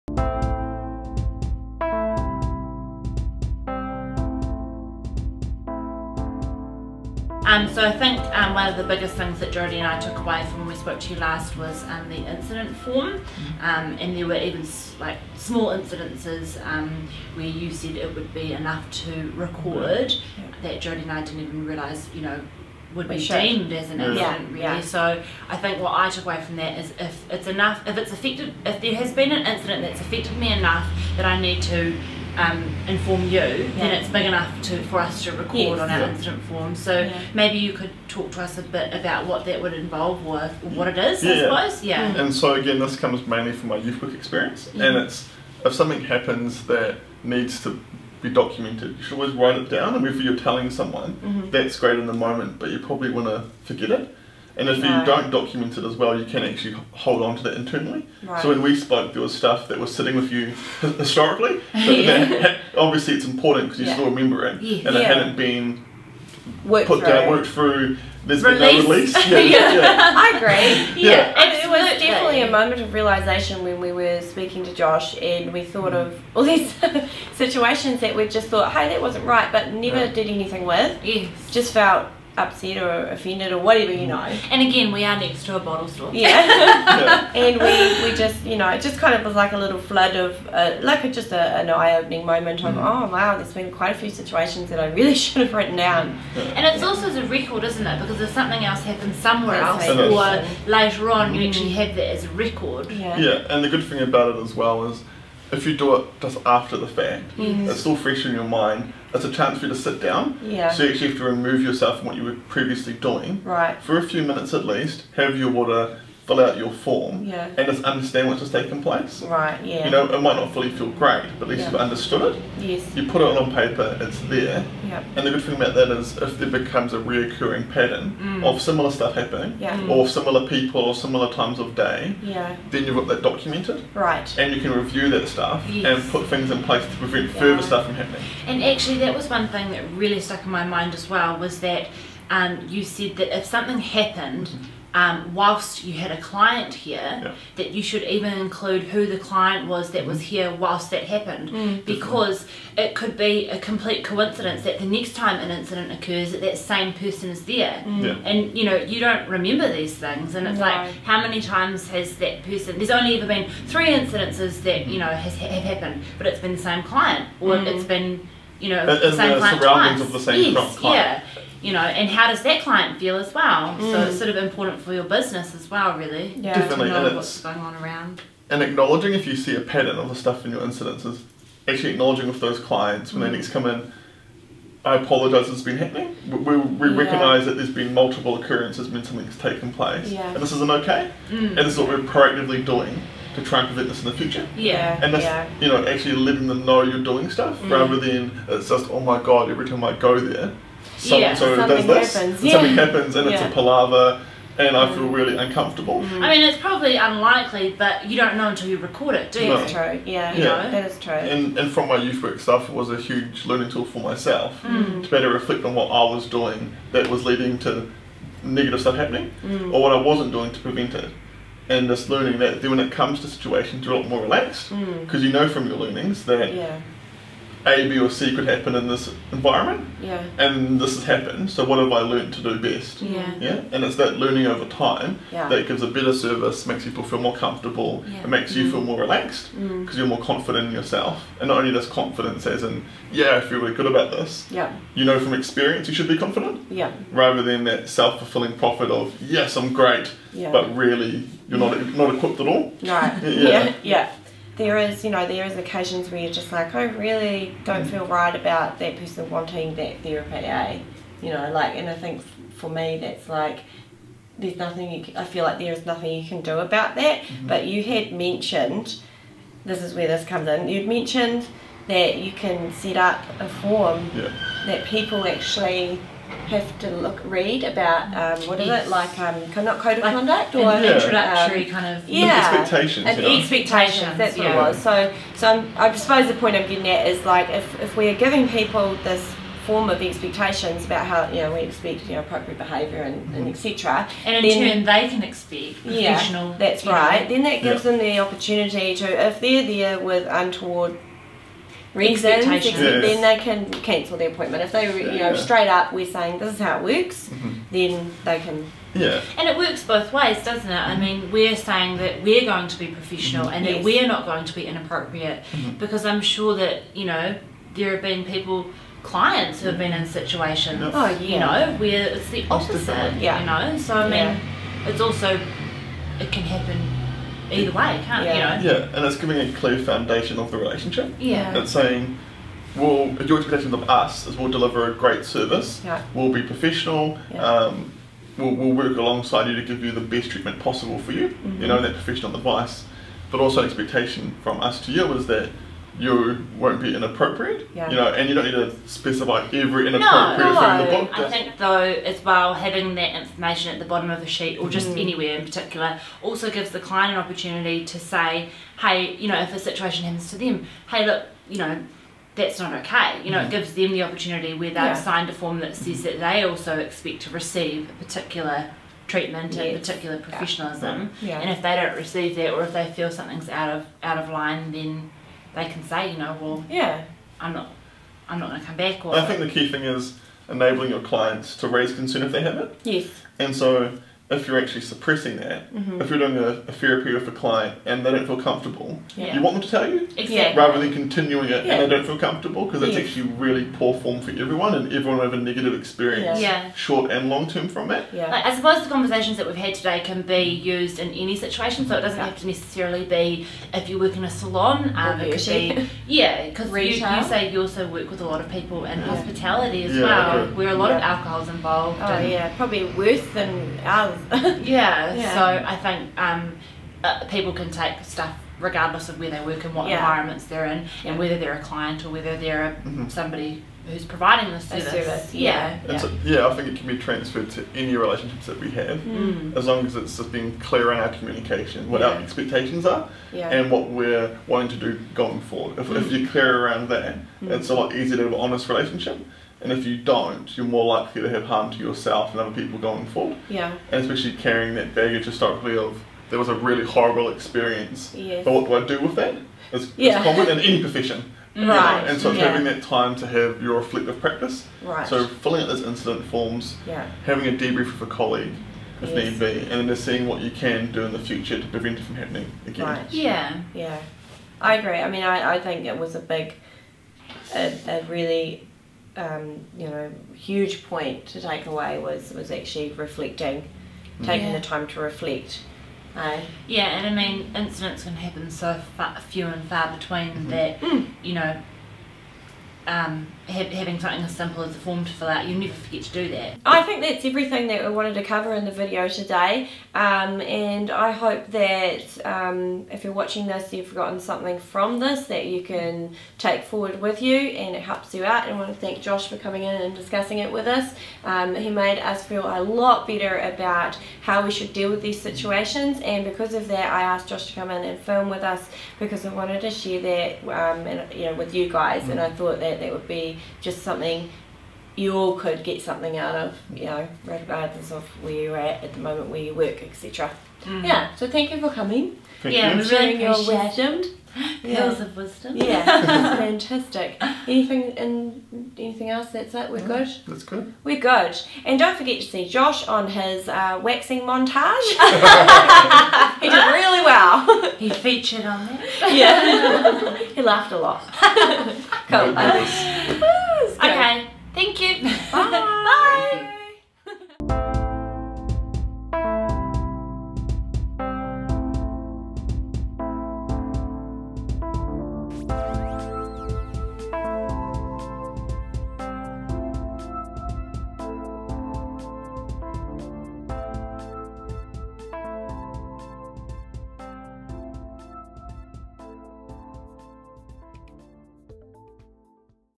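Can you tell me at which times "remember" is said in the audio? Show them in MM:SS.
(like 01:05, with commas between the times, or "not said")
01:04, 02:39.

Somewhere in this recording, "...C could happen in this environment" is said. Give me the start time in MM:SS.
03:48.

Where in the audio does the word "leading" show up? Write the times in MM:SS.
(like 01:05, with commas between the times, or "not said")
03:37.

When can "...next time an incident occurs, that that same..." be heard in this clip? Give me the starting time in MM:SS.
02:34.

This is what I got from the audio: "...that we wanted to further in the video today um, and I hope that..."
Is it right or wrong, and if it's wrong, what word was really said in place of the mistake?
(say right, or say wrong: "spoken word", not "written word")
wrong: "cover", not "further".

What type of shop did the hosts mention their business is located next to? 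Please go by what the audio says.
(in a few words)
A bottle store.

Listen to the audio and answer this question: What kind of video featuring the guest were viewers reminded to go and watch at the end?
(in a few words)
Waxing montage.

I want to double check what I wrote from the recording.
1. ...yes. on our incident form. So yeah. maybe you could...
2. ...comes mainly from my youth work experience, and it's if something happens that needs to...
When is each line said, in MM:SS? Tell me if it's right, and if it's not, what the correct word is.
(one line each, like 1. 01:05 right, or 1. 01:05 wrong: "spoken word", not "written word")
1. 00:35 right
2. 00:42 right.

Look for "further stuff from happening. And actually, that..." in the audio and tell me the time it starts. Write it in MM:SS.
02:17.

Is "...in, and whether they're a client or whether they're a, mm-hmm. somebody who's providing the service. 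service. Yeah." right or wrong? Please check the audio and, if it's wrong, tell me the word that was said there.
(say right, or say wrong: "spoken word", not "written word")
right.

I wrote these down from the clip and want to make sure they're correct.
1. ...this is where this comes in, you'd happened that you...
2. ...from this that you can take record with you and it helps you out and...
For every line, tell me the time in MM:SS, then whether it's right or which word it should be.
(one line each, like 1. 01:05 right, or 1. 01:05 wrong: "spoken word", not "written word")
1. 04:29 wrong: "mentioned", not "happened"
2. 08:14 wrong: "forward", not "record".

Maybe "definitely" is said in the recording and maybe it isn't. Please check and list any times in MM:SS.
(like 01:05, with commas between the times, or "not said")
01:12, 02:32, 02:56.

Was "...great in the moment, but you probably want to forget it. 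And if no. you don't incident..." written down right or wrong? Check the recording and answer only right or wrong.
wrong.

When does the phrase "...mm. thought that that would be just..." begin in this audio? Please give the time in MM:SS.
08:32.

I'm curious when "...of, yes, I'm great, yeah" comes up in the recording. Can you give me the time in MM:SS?
04:08.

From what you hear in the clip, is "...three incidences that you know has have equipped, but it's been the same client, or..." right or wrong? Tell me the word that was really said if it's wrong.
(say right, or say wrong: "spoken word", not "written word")
wrong: "happened", not "equipped".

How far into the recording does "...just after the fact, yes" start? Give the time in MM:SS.
01:46.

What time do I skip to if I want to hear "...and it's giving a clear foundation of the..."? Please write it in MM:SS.
05:28.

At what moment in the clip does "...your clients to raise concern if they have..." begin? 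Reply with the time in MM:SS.
06:20.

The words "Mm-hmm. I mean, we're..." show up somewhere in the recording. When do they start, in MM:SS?
05:10.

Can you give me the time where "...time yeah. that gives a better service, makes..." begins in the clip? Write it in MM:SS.
03:54.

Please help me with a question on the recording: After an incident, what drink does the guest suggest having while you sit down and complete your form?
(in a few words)
Water.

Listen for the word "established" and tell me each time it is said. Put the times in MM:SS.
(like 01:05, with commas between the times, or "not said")
not said.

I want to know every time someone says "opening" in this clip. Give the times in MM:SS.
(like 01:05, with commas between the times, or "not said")
01:31.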